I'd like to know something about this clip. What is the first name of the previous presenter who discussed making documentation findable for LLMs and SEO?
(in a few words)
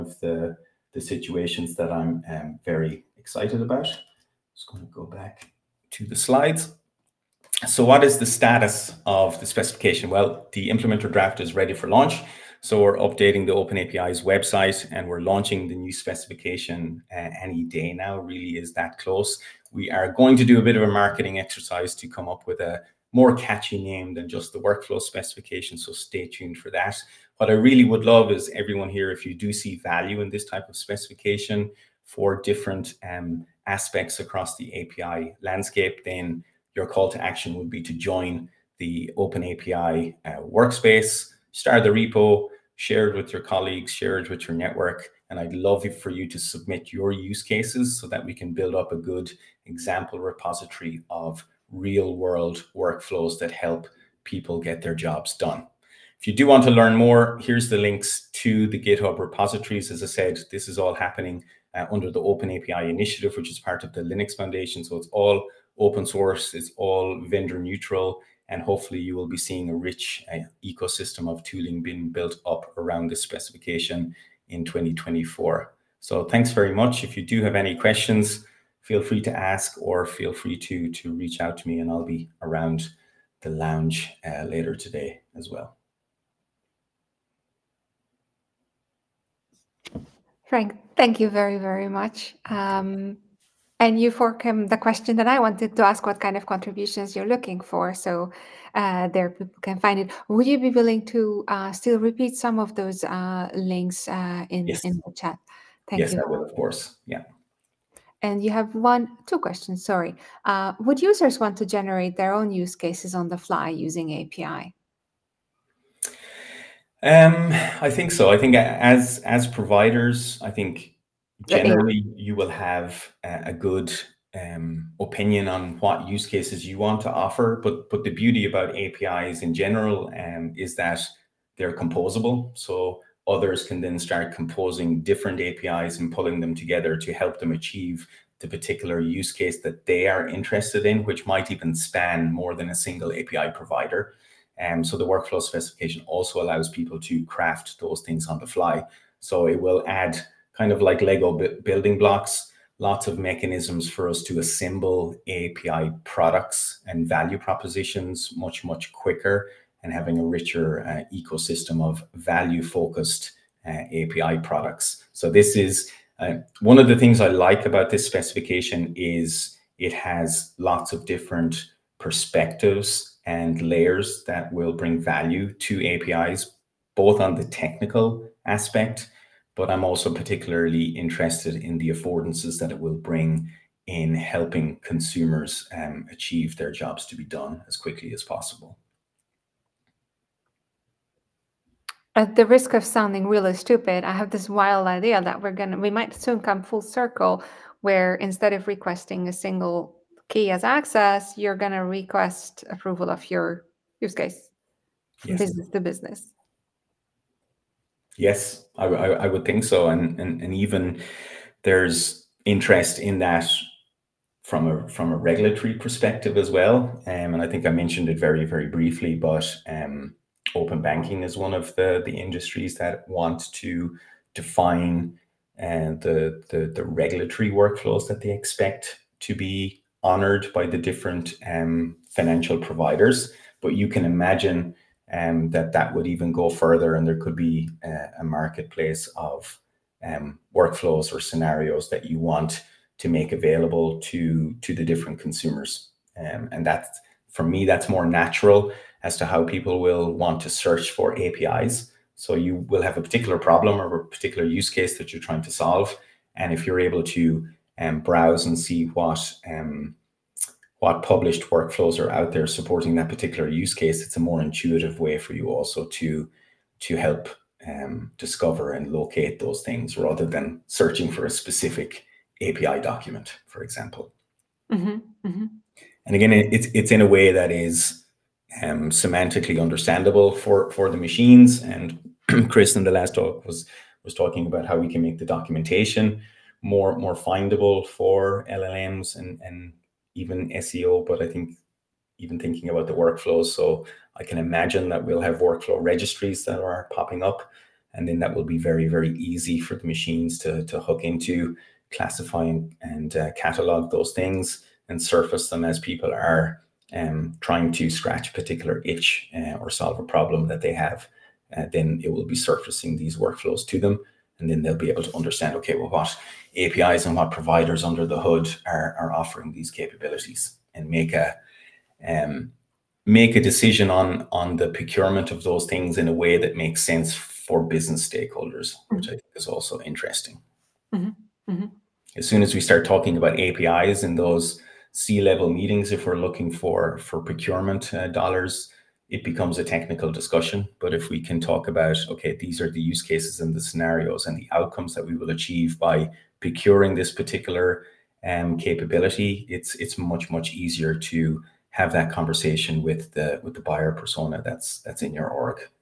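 Chris.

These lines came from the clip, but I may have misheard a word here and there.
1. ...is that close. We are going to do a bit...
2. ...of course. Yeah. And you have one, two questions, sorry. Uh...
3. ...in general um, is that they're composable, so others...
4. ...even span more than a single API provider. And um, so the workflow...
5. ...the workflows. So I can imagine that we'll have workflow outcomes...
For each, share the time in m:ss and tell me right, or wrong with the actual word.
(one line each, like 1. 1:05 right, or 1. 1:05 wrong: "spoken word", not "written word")
1. 0:18 right
2. 1:46 right
3. 2:09 right
4. 2:21 right
5. 4:52 wrong: "registries", not "outcomes".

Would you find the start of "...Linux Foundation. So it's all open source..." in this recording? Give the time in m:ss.
1:04.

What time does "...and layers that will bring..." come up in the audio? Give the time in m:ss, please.
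2:53.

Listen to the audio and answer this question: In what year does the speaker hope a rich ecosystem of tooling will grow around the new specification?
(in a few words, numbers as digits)
2024.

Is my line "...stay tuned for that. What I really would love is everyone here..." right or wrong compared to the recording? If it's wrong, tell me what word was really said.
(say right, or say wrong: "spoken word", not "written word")
right.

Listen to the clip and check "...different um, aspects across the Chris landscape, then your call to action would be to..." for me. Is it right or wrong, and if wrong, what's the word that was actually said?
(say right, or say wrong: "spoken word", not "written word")
wrong: "API", not "Chris".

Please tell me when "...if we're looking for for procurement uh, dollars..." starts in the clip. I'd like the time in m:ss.
5:35.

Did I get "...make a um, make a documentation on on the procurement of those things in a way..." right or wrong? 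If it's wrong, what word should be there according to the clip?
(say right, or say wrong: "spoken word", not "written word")
wrong: "decision", not "documentation".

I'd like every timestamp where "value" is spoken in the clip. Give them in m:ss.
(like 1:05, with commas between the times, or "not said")
0:29, 2:37, 2:42, 2:55.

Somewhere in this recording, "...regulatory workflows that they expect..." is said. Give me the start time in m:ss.
3:46.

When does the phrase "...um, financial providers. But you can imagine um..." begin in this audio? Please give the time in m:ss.
3:51.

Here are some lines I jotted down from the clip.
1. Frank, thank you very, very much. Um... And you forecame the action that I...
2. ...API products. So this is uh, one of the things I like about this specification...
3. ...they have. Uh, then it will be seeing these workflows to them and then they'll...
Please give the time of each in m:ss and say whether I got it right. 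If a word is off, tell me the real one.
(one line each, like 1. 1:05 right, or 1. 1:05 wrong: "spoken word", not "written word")
1. 1:30 wrong: "question", not "action"
2. 2:44 right
3. 5:10 wrong: "surfacing", not "seeing".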